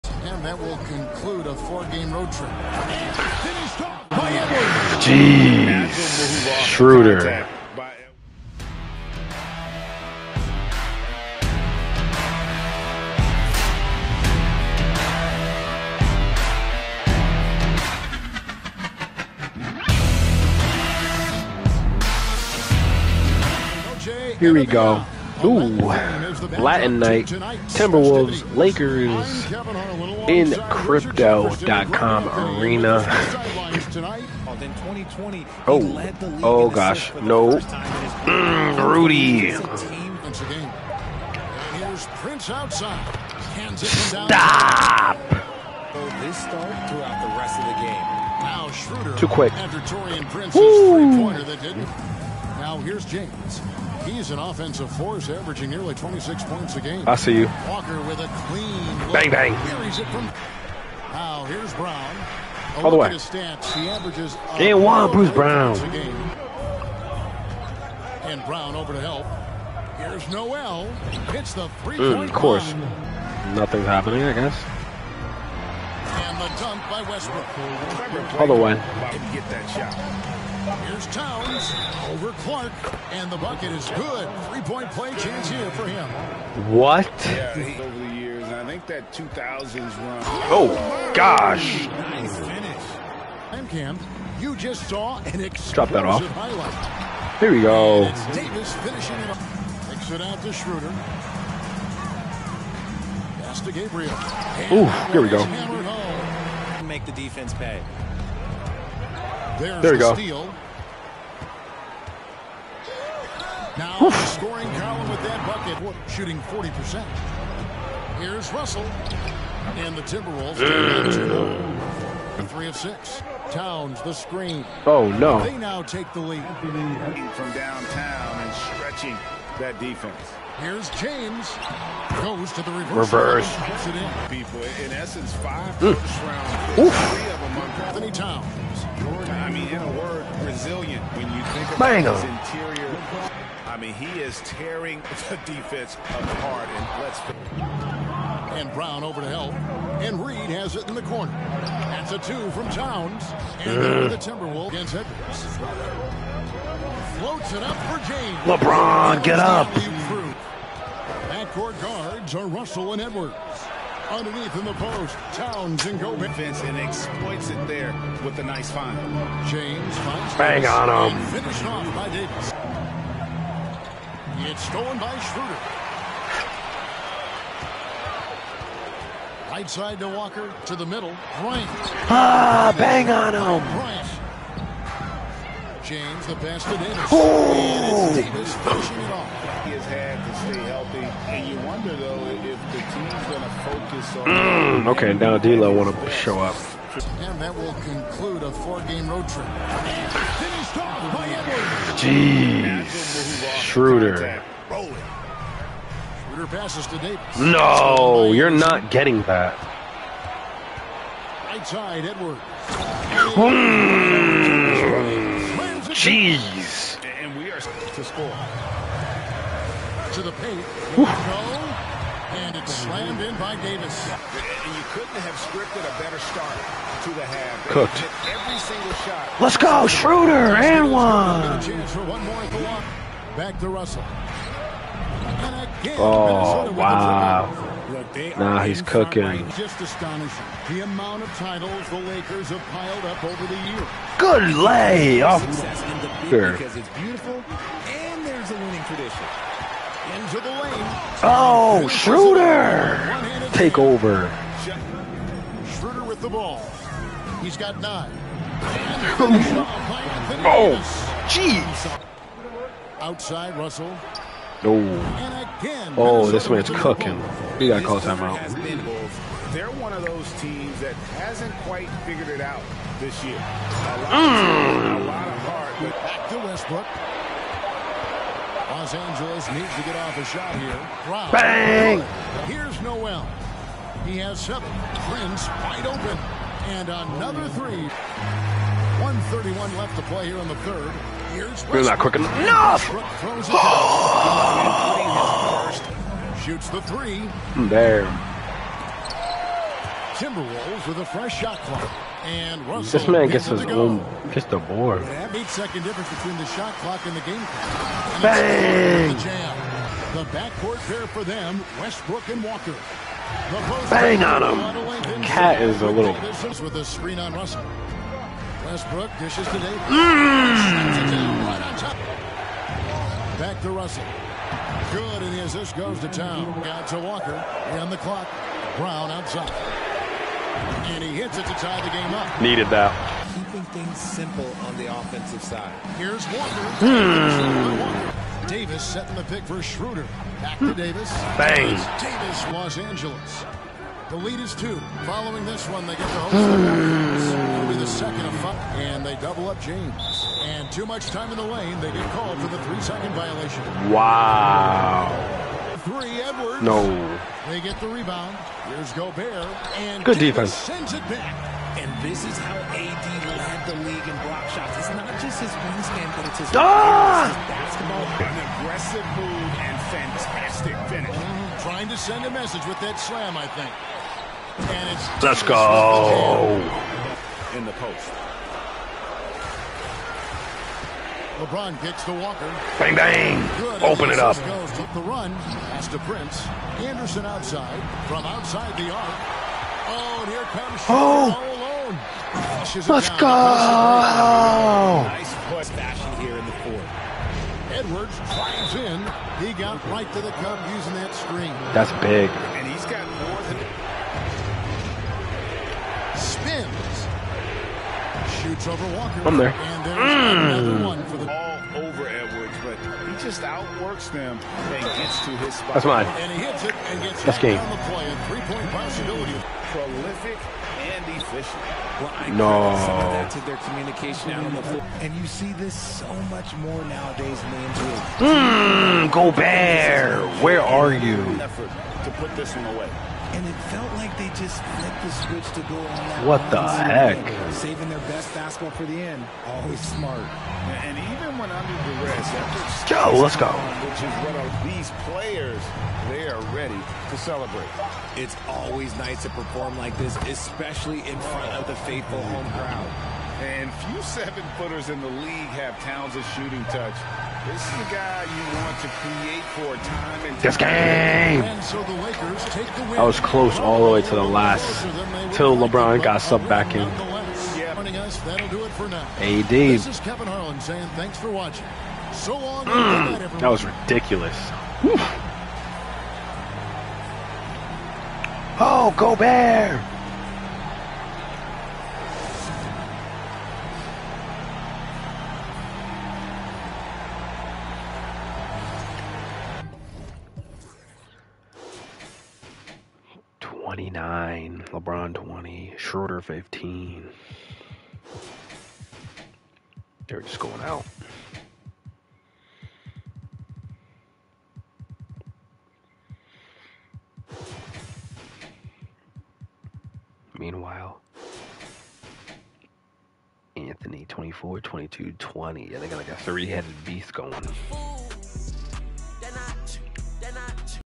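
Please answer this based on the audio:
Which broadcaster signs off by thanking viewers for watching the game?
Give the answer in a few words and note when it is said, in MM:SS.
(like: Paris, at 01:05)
Kevin Harlan, at 07:50.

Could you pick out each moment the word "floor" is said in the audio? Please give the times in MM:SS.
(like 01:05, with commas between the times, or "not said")
07:04.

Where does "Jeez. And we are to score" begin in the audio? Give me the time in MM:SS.
03:35.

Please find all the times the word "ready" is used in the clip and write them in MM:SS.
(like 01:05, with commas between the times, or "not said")
07:26.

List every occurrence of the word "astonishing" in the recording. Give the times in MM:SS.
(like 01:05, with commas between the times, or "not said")
03:59.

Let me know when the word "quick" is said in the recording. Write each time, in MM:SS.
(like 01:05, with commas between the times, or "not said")
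00:49, 04:51.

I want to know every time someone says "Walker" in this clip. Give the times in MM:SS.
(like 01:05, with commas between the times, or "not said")
00:57, 03:00, 05:12, 05:26, 05:36, 06:22.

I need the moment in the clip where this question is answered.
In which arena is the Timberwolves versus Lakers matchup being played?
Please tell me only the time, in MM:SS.
00:30.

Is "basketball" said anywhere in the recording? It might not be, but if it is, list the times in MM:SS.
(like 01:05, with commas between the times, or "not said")
06:07, 07:18.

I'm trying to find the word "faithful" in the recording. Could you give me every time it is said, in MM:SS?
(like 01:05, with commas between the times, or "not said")
07:31.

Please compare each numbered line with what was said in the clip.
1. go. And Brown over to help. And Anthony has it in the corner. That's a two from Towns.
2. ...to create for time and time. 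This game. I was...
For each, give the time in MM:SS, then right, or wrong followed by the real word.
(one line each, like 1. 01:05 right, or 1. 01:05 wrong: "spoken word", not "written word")
1. 02:27 wrong: "Reid", not "Anthony"
2. 07:38 right.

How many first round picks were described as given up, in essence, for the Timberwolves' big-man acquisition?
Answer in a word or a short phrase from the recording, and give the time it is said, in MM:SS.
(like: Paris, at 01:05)
5, at 02:15.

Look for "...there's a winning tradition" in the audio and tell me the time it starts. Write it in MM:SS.
04:08.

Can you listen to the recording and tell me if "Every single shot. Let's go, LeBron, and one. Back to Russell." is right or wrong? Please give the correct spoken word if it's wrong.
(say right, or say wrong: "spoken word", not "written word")
wrong: "Schroeder", not "LeBron".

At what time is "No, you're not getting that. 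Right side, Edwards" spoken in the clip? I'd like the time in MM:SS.
03:27.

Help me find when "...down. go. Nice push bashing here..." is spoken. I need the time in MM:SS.
06:33.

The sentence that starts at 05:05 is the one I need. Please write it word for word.
That difference between the shot clock and the game clock.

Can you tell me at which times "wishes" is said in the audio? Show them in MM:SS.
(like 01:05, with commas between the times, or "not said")
not said.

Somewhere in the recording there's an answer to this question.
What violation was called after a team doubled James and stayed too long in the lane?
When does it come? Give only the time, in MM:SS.
05:52.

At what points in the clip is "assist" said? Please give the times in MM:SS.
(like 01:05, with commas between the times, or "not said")
05:25.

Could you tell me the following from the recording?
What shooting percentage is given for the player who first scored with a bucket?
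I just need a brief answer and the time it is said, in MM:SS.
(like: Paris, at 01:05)
40%, at 01:56.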